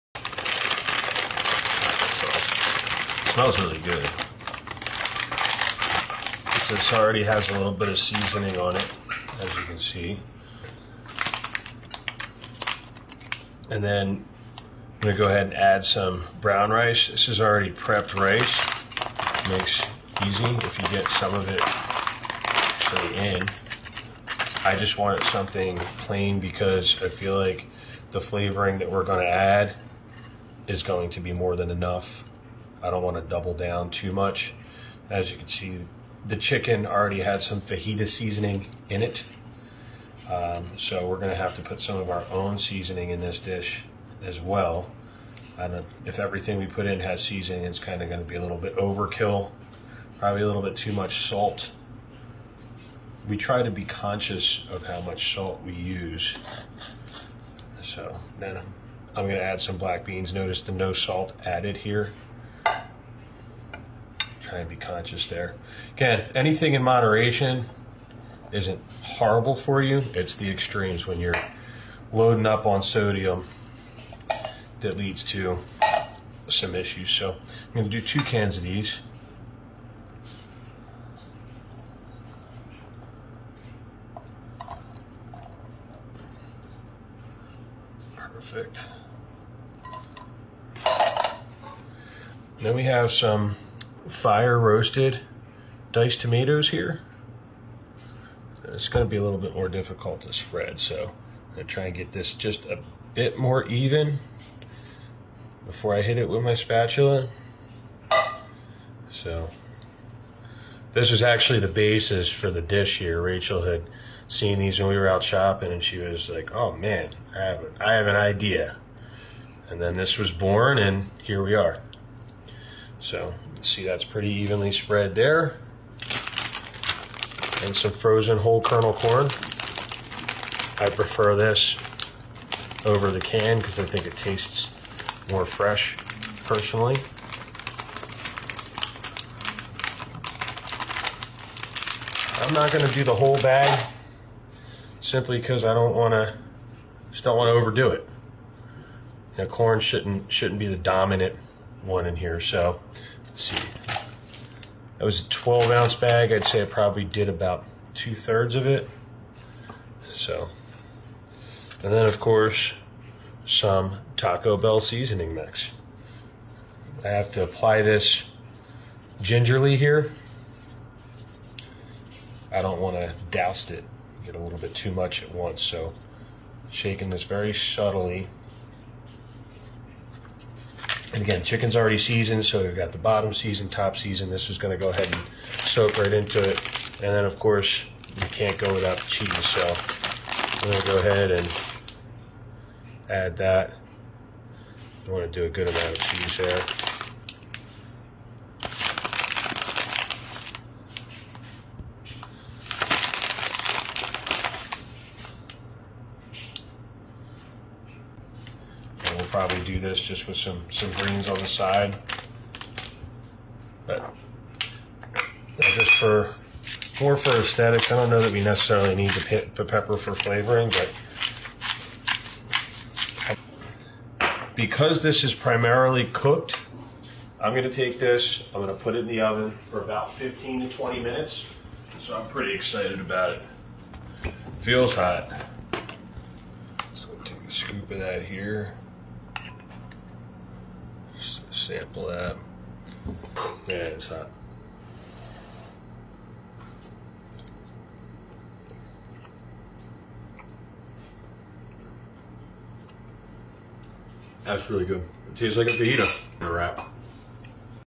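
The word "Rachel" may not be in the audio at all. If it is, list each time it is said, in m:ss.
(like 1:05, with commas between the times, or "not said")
1:53.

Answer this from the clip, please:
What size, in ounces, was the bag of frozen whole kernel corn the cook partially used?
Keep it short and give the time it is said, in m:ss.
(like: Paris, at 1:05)
12 ounce, at 2:35.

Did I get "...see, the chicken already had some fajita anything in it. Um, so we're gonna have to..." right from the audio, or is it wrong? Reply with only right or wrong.
wrong.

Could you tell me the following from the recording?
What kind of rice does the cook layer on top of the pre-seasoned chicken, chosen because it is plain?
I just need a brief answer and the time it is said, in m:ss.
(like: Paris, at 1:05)
brown rice, at 0:16.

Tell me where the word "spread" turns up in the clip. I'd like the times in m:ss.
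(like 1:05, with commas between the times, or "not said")
1:40, 2:04.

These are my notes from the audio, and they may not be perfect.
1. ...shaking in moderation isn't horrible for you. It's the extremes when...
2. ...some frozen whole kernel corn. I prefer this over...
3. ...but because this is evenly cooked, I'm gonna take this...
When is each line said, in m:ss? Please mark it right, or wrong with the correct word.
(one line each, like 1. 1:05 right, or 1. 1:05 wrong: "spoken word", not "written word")
1. 1:06 wrong: "anything", not "shaking"
2. 2:07 right
3. 3:44 wrong: "primarily", not "evenly".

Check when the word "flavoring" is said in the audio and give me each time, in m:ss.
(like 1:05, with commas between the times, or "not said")
0:28, 3:40.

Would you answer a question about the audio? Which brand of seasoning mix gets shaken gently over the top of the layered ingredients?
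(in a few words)
Taco Bell.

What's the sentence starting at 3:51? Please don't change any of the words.
So I'm pretty excited about it.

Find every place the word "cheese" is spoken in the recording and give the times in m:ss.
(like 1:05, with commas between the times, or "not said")
3:09, 3:15.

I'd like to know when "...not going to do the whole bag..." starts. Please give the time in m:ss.
2:22.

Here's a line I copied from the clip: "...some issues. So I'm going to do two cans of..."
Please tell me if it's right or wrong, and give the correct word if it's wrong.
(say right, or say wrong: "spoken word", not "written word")
right.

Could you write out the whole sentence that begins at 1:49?
So this is actually the basis for the dish here.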